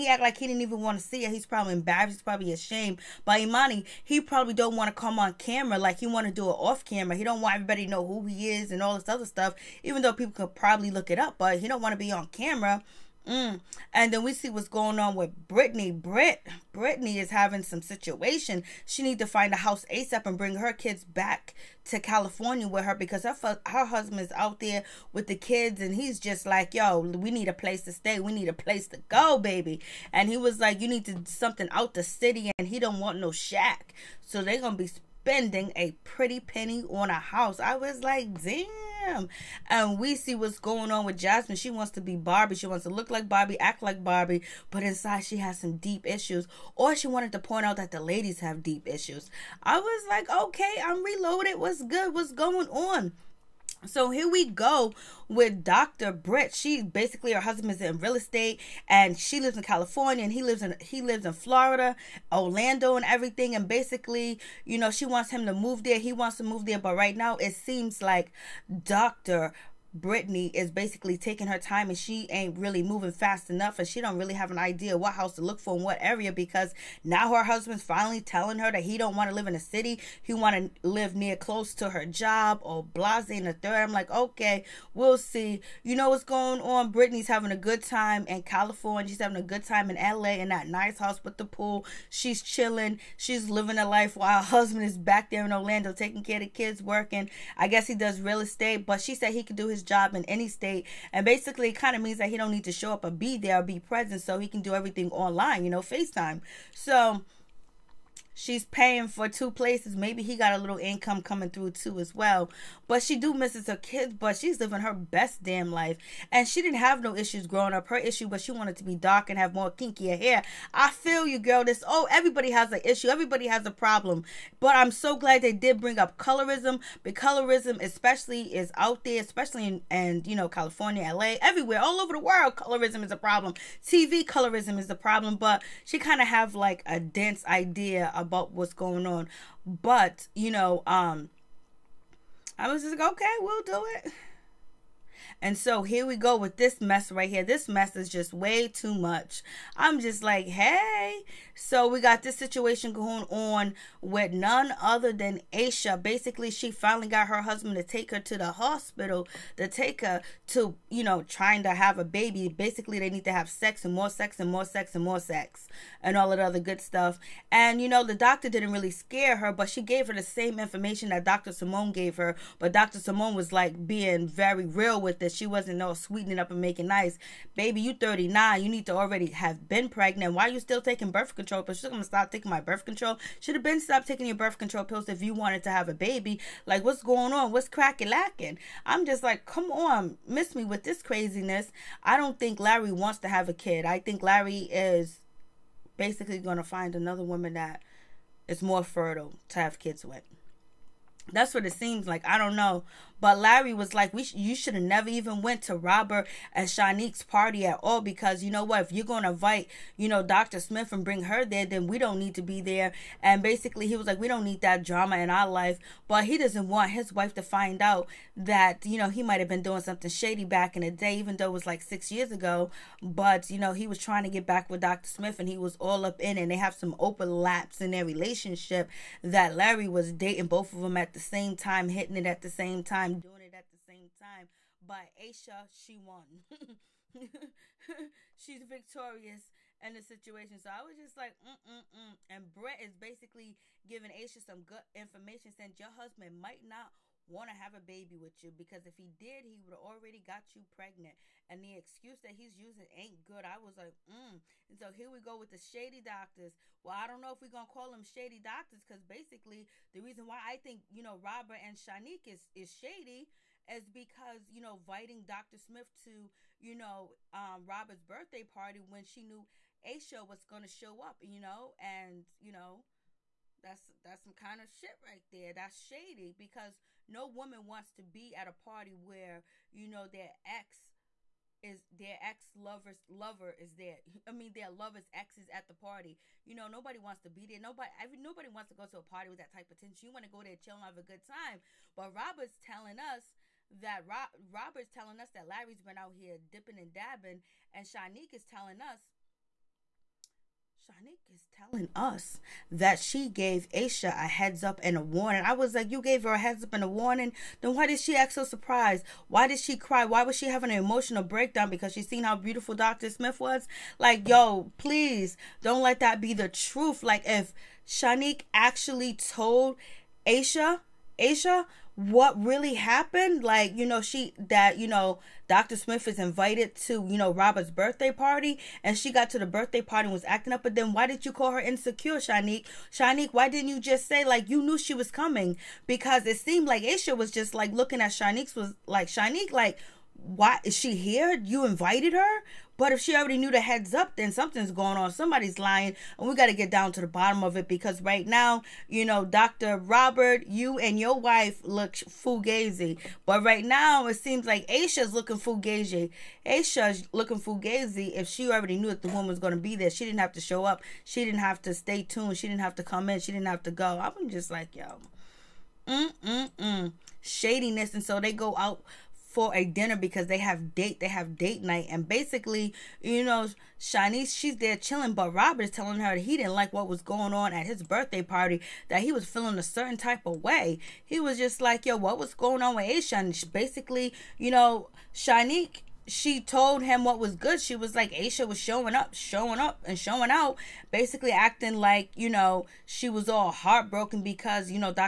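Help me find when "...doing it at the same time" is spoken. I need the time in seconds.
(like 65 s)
233 s.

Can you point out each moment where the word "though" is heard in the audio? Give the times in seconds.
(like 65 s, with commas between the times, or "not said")
10 s, 221 s.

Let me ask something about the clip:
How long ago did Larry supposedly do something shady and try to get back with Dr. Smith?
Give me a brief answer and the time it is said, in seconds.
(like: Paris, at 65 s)
6 years ago, at 221 s.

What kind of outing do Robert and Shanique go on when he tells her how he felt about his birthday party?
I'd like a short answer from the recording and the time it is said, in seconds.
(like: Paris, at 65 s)
Date night, at 371 s.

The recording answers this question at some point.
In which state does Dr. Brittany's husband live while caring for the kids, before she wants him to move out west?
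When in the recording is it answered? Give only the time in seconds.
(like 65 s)
61 s.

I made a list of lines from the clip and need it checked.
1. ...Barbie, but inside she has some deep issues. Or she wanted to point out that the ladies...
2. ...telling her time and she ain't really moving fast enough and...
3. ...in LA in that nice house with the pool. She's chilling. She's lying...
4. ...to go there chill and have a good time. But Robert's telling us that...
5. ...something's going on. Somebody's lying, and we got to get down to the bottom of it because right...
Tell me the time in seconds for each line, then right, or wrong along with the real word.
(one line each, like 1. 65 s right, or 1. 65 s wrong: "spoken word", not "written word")
1. 44 s right
2. 71 s wrong: "taking", not "telling"
3. 89 s wrong: "living", not "lying"
4. 290 s right
5. 344 s right.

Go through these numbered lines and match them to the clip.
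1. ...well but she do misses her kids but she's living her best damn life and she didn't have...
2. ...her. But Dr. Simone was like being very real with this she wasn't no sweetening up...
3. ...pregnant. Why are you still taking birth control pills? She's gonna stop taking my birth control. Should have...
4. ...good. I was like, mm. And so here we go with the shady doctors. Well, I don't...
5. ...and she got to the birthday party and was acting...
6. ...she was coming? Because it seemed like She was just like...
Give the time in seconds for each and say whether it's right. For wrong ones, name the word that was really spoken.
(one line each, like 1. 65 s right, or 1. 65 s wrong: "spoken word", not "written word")
1. 112 s right
2. 172 s right
3. 179 s right
4. 253 s right
5. 328 s right
6. 334 s wrong: "Aisha", not "She".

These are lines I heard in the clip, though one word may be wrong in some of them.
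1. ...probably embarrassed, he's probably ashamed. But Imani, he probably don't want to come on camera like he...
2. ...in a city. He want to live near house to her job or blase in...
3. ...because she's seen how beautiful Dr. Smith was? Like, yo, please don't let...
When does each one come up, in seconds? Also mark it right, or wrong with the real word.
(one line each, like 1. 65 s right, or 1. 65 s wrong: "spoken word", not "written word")
1. 1 s right
2. 79 s wrong: "close", not "house"
3. 311 s right.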